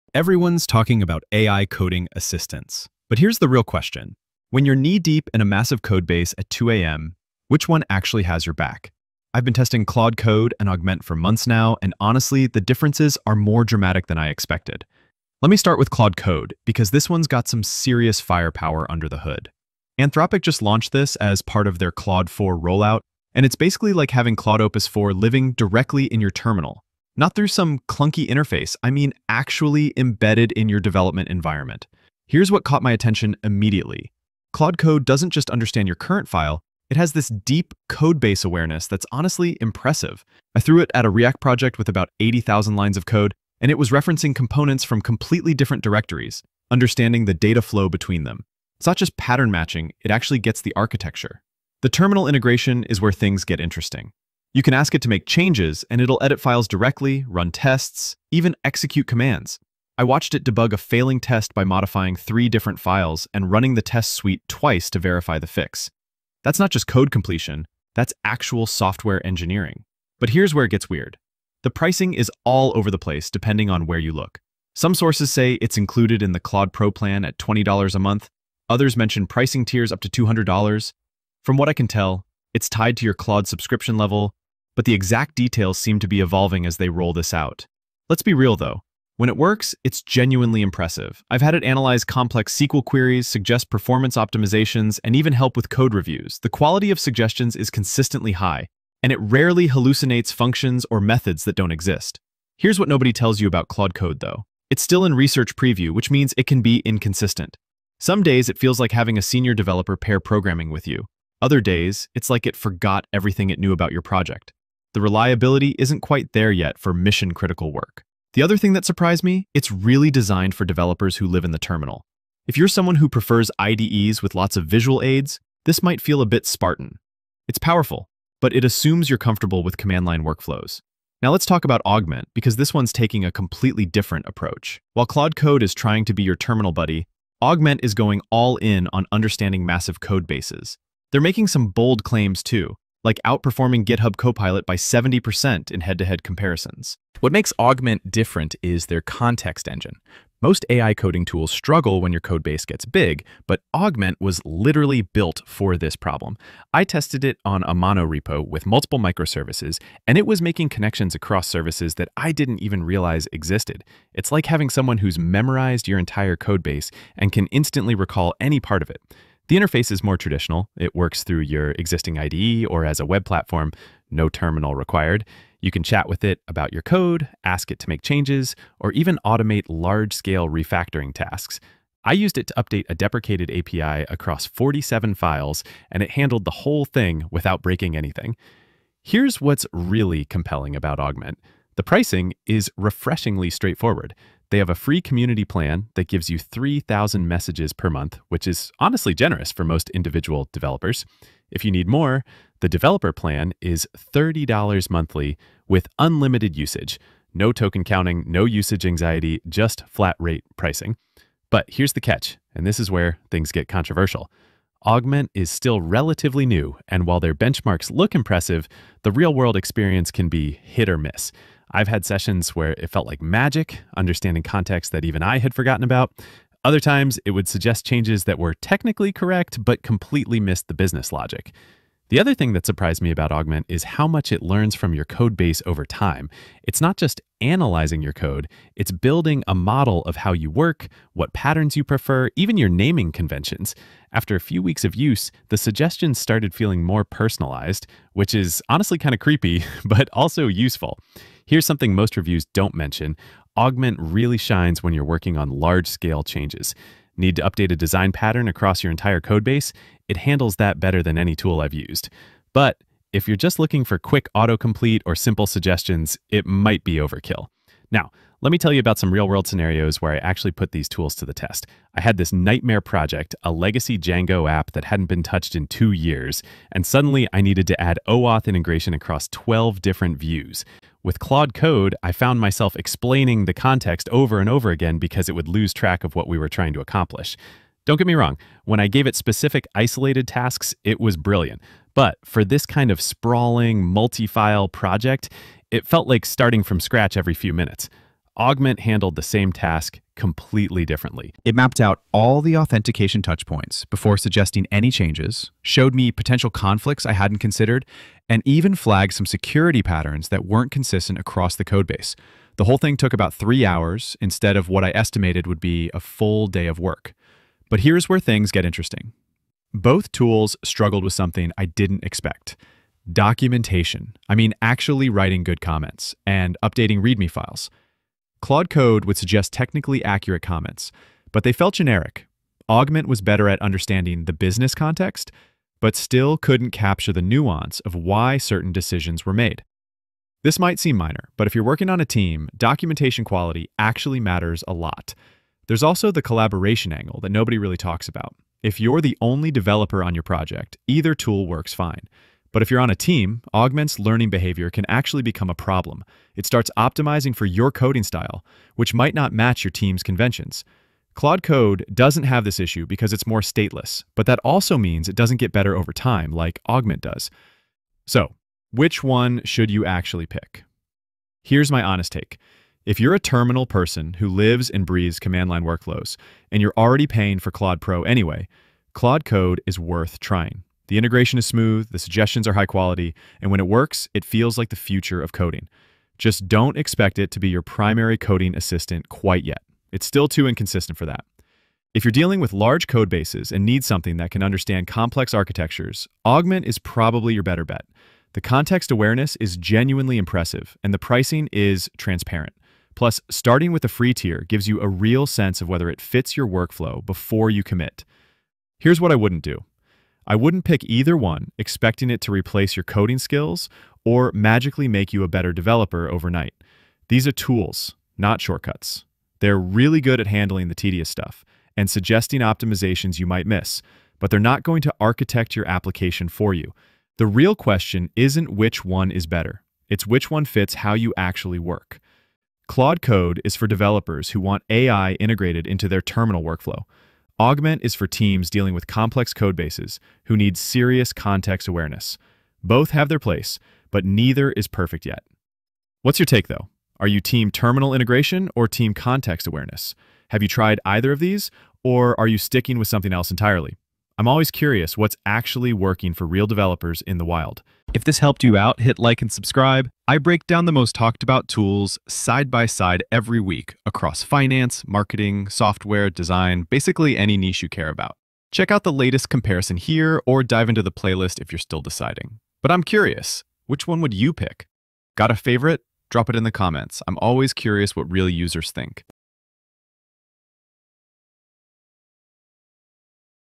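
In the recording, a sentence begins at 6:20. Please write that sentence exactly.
The integration is smooth, the suggestions are high quality, and when it works, it feels like the future of coding.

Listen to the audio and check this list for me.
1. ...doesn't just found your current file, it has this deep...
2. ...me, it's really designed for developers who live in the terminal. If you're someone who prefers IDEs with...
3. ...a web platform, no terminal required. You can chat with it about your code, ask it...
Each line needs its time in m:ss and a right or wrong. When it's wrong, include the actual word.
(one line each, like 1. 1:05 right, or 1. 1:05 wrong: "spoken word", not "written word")
1. 0:35 wrong: "understand", not "found"
2. 1:59 right
3. 2:53 right.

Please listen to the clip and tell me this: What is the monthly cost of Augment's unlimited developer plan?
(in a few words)
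$30.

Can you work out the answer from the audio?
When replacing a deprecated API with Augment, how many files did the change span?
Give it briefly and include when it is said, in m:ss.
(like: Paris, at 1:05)
47, at 3:04.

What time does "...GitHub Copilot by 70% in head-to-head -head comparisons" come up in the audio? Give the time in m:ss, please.
2:23.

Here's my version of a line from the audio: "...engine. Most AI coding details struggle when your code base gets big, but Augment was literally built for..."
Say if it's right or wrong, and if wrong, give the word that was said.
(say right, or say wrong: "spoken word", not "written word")
wrong: "tools", not "details".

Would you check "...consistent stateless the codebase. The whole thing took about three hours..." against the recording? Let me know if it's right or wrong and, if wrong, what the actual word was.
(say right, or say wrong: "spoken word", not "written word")
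wrong: "across", not "stateless".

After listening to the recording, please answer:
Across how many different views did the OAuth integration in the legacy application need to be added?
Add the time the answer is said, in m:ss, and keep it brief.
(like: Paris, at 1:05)
12, at 4:39.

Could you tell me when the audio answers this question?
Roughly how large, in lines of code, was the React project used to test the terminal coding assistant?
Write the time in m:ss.
0:42.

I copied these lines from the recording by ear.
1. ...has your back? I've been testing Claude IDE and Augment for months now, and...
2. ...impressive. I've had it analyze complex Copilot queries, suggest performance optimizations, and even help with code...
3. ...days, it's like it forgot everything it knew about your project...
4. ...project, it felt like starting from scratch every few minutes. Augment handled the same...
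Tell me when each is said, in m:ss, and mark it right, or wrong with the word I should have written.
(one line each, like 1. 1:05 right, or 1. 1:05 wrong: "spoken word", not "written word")
1. 0:08 wrong: "Code", not "IDE"
2. 1:30 wrong: "SQL", not "Copilot"
3. 1:51 right
4. 4:54 right.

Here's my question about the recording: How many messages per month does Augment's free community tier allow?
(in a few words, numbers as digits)
3,000.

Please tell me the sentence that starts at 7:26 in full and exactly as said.
Are you team terminal integration or team context awareness?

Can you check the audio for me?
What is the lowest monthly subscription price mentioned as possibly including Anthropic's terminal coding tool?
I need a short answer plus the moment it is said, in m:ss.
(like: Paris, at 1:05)
$20, at 1:17.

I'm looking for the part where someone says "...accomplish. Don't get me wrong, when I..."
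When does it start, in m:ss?
4:46.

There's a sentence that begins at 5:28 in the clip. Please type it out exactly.
Claude Code would suggest technically accurate comments, but they felt generic.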